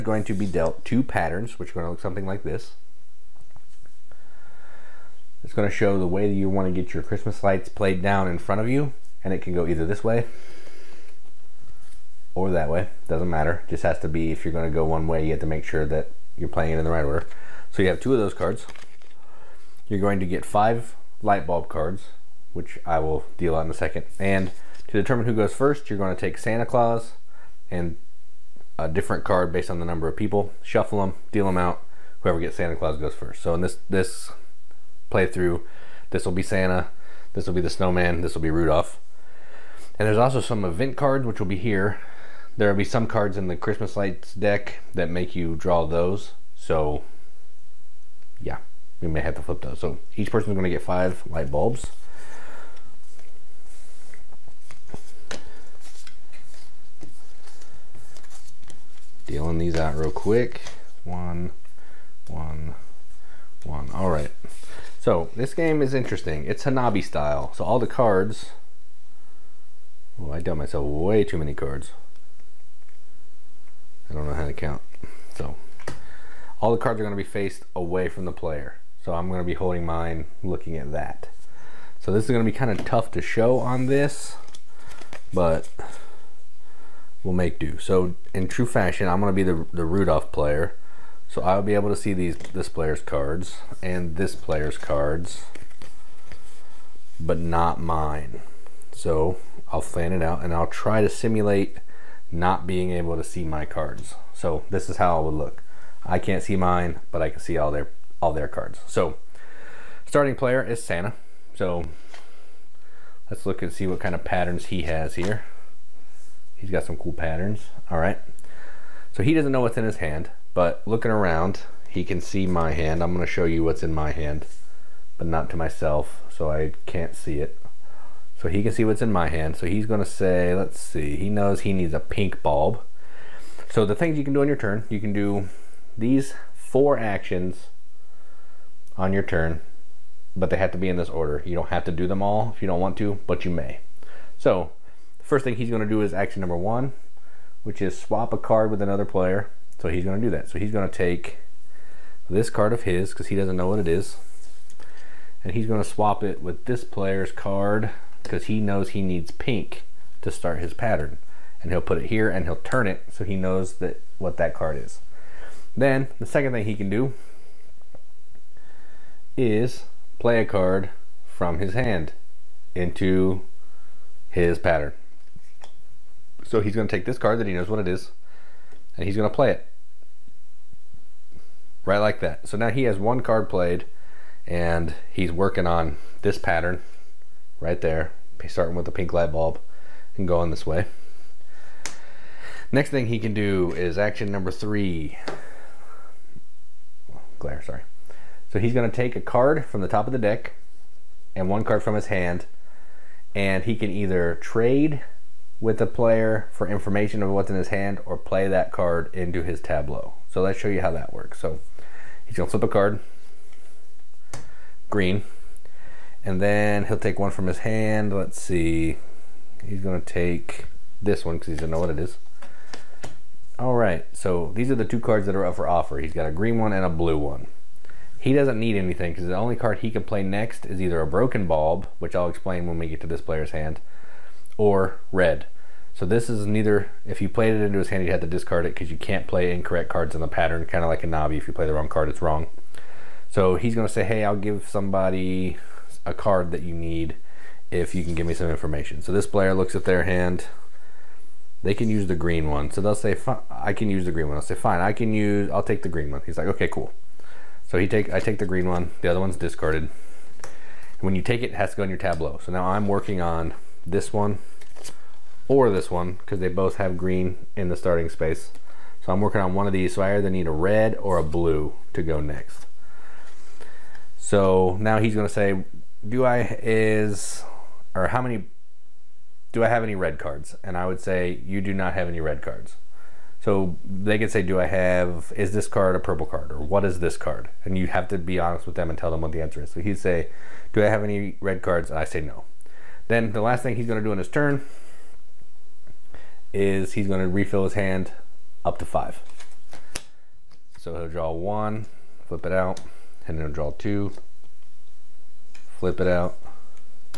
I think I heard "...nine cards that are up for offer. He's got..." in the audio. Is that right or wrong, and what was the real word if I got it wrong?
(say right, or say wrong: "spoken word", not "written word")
wrong: "two", not "nine".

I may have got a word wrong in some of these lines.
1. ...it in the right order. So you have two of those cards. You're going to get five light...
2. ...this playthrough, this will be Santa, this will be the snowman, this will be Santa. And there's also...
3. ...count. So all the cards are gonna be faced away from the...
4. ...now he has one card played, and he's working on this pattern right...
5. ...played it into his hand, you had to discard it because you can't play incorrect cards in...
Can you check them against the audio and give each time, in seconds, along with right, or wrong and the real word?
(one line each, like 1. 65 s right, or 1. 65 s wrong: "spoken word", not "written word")
1. 16 s right
2. 33 s wrong: "Rudolph", not "Santa"
3. 74 s right
4. 182 s right
5. 237 s right.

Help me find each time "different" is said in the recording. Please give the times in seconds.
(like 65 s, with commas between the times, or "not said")
28 s.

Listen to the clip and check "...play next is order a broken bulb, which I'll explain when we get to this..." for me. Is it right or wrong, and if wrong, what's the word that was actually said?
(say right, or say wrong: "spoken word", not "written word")
wrong: "either", not "order".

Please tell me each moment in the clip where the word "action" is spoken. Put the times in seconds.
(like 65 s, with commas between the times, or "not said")
136 s, 146 s, 193 s.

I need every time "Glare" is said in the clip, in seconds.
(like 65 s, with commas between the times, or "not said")
197 s.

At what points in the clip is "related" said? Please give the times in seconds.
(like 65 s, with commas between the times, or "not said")
not said.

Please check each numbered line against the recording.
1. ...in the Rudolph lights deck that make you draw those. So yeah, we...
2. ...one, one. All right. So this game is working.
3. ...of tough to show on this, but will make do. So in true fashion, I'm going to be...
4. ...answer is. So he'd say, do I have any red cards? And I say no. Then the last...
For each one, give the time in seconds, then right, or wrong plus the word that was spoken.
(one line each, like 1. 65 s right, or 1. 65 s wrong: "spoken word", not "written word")
1. 43 s wrong: "Christmas", not "Rudolph"
2. 62 s wrong: "interesting", not "working"
3. 82 s right
4. 289 s right.